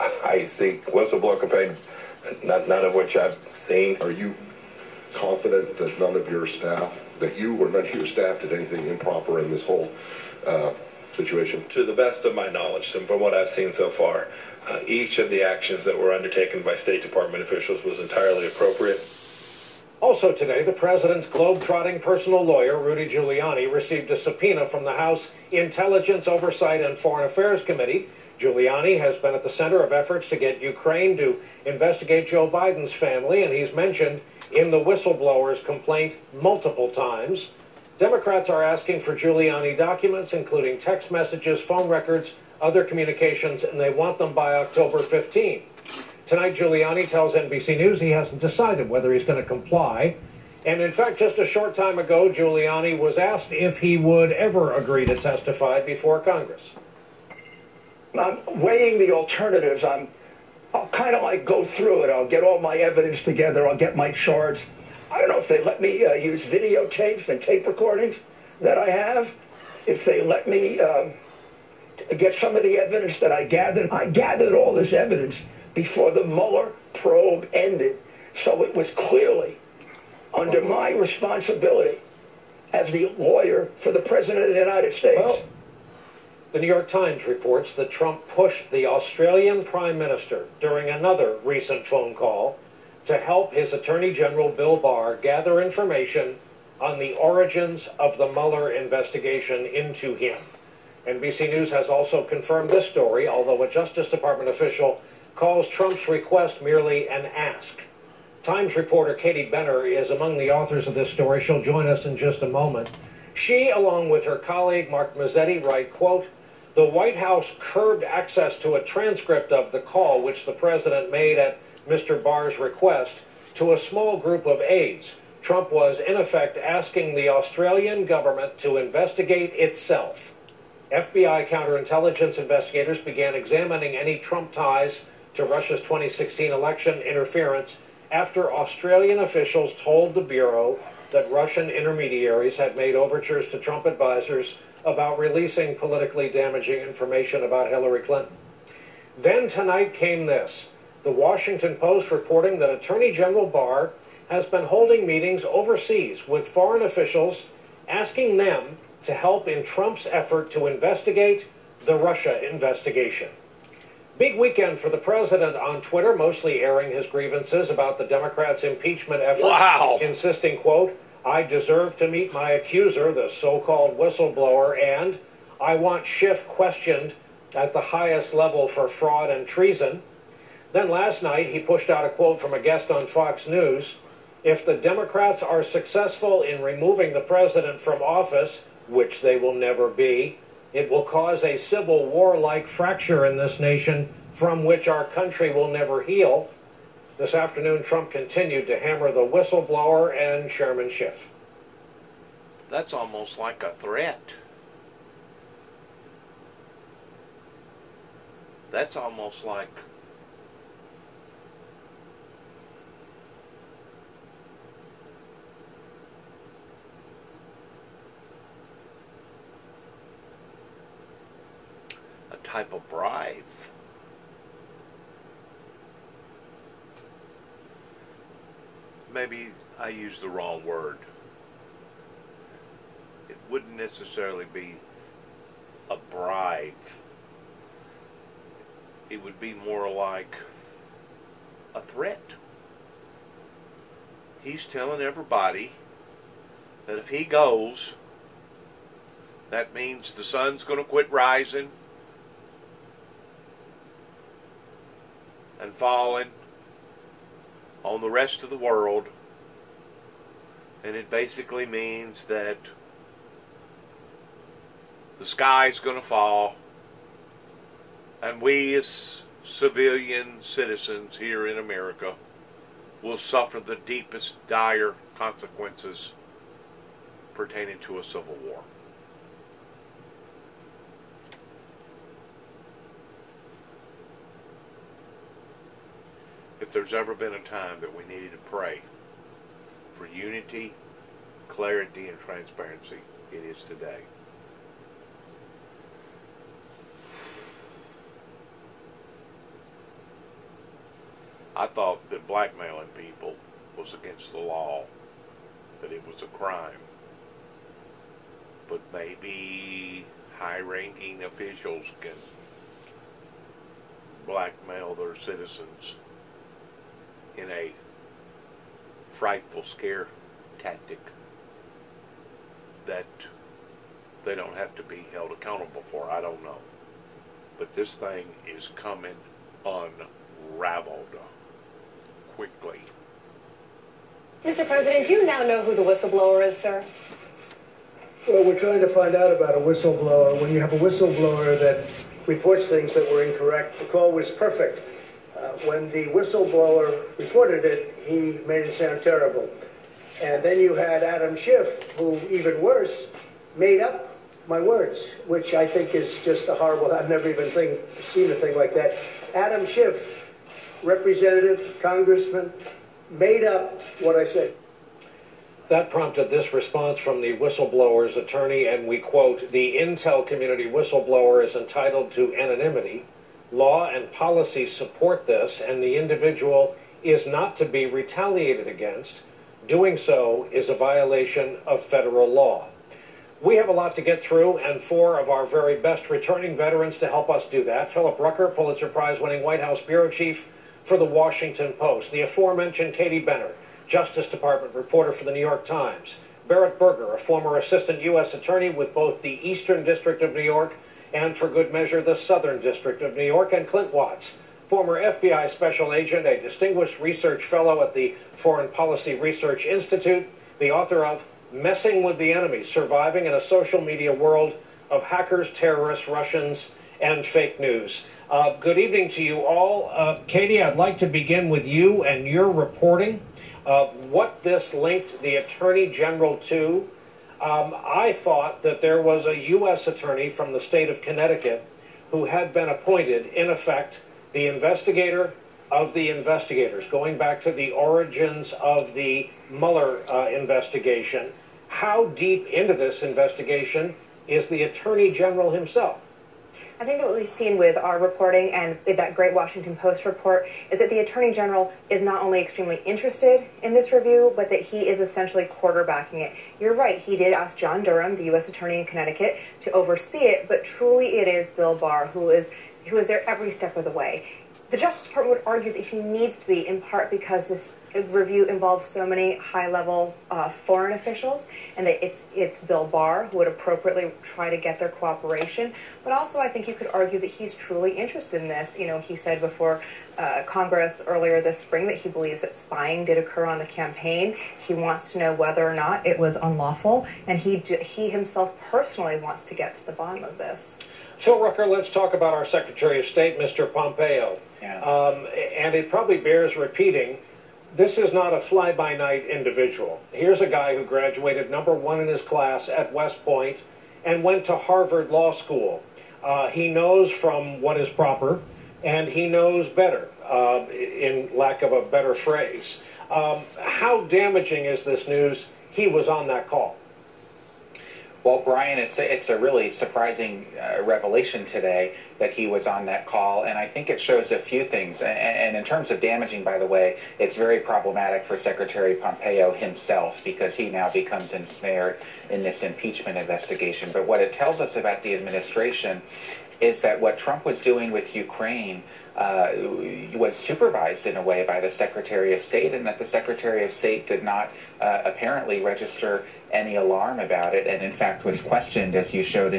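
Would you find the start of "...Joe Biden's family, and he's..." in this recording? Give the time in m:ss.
0:32.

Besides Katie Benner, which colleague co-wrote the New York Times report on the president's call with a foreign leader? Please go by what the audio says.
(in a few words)
Mark Mazzetti.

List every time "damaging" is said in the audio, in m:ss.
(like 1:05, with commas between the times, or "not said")
2:26, 8:34, 8:46.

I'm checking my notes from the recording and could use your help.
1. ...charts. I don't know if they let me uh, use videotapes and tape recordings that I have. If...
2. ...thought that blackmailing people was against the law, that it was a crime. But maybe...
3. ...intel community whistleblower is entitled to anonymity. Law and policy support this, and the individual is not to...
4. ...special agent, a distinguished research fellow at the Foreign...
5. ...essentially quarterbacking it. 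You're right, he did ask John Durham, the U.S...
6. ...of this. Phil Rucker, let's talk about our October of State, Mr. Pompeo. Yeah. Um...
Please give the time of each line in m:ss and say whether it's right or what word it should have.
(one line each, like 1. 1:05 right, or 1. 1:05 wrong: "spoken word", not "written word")
1. 1:04 right
2. 5:01 right
3. 6:09 right
4. 6:45 right
5. 7:34 right
6. 8:10 wrong: "Secretary", not "October".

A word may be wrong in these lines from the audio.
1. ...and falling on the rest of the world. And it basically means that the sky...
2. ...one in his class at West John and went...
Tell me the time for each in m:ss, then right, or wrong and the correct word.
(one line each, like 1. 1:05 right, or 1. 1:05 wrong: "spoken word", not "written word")
1. 4:15 right
2. 8:21 wrong: "Point", not "John".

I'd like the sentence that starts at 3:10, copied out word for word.
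It will cause a civil war like fracture in this nation from which our country will never heal.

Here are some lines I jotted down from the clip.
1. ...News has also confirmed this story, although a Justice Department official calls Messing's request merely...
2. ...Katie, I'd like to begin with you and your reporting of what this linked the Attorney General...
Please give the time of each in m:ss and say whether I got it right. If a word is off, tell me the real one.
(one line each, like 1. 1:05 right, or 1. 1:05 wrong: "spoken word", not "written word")
1. 1:41 wrong: "Trump", not "Messing"
2. 7:00 right.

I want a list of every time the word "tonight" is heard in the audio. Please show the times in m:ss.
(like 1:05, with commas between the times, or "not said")
0:46, 2:29.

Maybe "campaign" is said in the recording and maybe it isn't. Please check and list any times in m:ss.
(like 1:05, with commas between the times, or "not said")
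0:01, 8:03.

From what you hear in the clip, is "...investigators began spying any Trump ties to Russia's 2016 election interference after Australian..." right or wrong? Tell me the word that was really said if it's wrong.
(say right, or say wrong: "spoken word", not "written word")
wrong: "examining", not "spying".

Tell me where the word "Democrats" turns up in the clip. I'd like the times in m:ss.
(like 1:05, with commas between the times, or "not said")
0:37, 2:48, 3:04.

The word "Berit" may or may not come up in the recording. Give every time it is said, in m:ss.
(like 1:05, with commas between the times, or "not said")
6:36.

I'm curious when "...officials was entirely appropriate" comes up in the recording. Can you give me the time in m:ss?
0:17.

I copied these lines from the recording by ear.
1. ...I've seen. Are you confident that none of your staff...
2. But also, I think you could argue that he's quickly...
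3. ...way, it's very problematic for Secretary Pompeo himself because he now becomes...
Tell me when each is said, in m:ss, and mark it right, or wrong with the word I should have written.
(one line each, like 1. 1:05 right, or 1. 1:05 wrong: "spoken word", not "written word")
1. 0:03 right
2. 7:56 wrong: "truly", not "quickly"
3. 8:46 right.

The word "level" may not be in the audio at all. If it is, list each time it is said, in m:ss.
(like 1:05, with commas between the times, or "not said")
2:58, 7:49.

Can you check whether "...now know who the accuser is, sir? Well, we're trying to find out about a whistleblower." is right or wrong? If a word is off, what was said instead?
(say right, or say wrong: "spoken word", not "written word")
wrong: "whistleblower", not "accuser".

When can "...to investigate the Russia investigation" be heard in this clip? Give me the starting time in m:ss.
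2:40.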